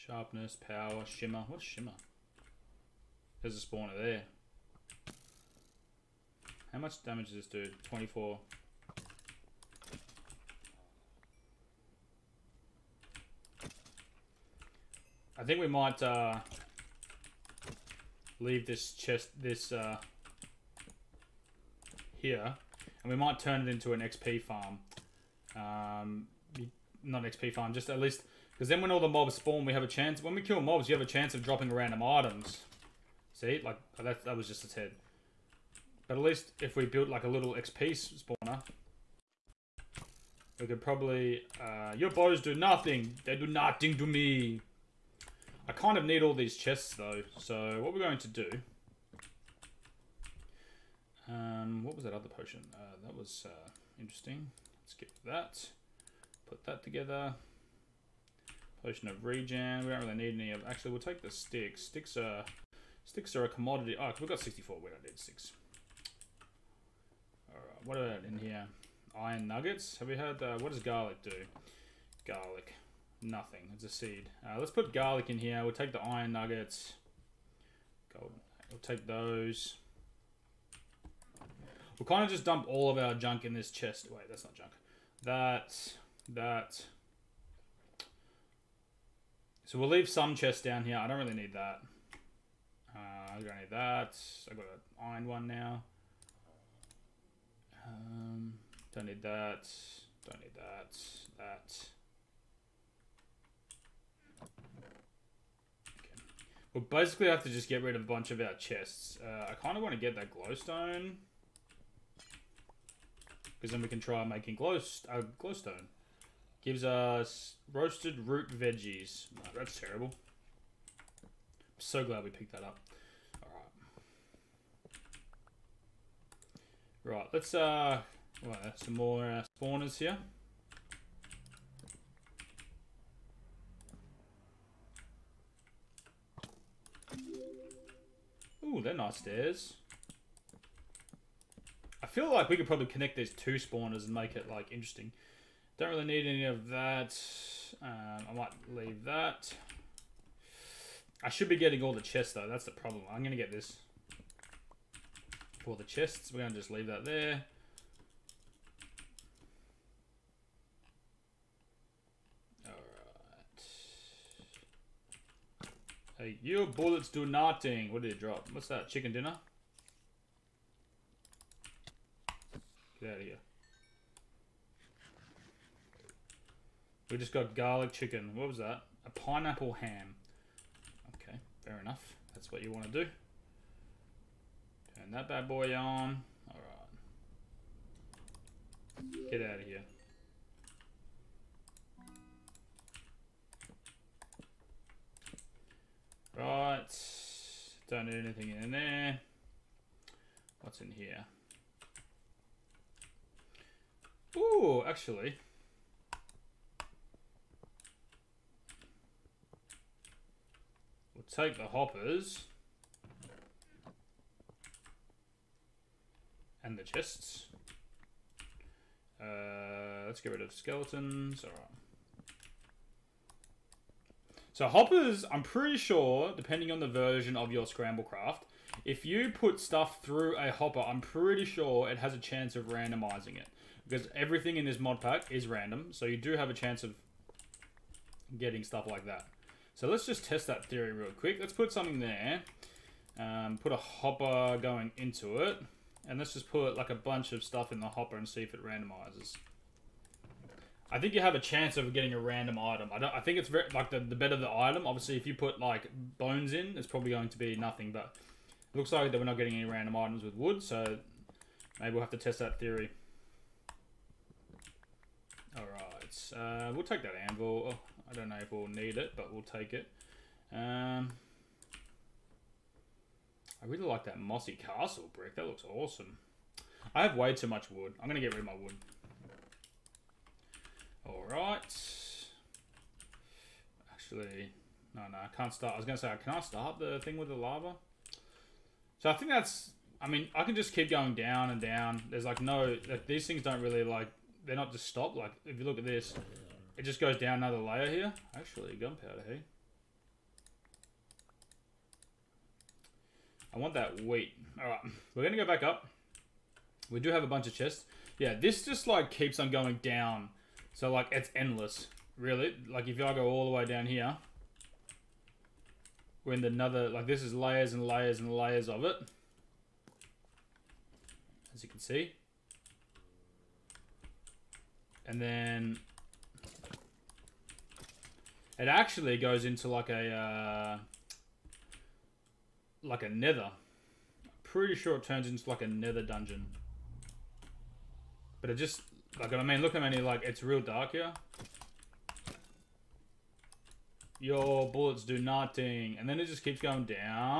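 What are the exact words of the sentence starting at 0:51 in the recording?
Um, what was that other potion?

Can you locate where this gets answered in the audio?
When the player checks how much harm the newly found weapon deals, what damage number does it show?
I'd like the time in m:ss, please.
0:07.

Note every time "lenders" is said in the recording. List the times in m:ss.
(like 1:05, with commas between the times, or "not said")
not said.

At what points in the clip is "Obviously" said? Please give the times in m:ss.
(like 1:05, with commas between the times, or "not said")
4:14.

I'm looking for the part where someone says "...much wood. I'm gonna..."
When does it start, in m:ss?
4:37.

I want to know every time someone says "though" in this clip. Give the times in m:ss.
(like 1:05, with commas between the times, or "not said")
0:46, 2:32.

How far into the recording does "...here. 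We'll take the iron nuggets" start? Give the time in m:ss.
1:15.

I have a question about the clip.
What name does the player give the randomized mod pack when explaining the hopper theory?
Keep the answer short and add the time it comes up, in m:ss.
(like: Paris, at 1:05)
Scramblecraft, at 3:47.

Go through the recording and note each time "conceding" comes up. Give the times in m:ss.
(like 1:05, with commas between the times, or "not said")
not said.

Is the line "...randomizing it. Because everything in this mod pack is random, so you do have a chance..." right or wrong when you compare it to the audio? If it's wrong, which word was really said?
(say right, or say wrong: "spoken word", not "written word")
right.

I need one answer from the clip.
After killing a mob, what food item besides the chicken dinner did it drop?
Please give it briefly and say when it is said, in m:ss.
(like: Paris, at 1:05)
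Pineapple ham, at 2:59.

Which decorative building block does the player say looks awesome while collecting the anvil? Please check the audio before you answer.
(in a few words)
Mossy castle brick.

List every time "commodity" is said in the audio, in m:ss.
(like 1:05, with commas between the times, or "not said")
1:03.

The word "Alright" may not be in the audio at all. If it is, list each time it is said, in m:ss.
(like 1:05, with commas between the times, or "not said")
1:07, 2:03, 3:06, 3:41.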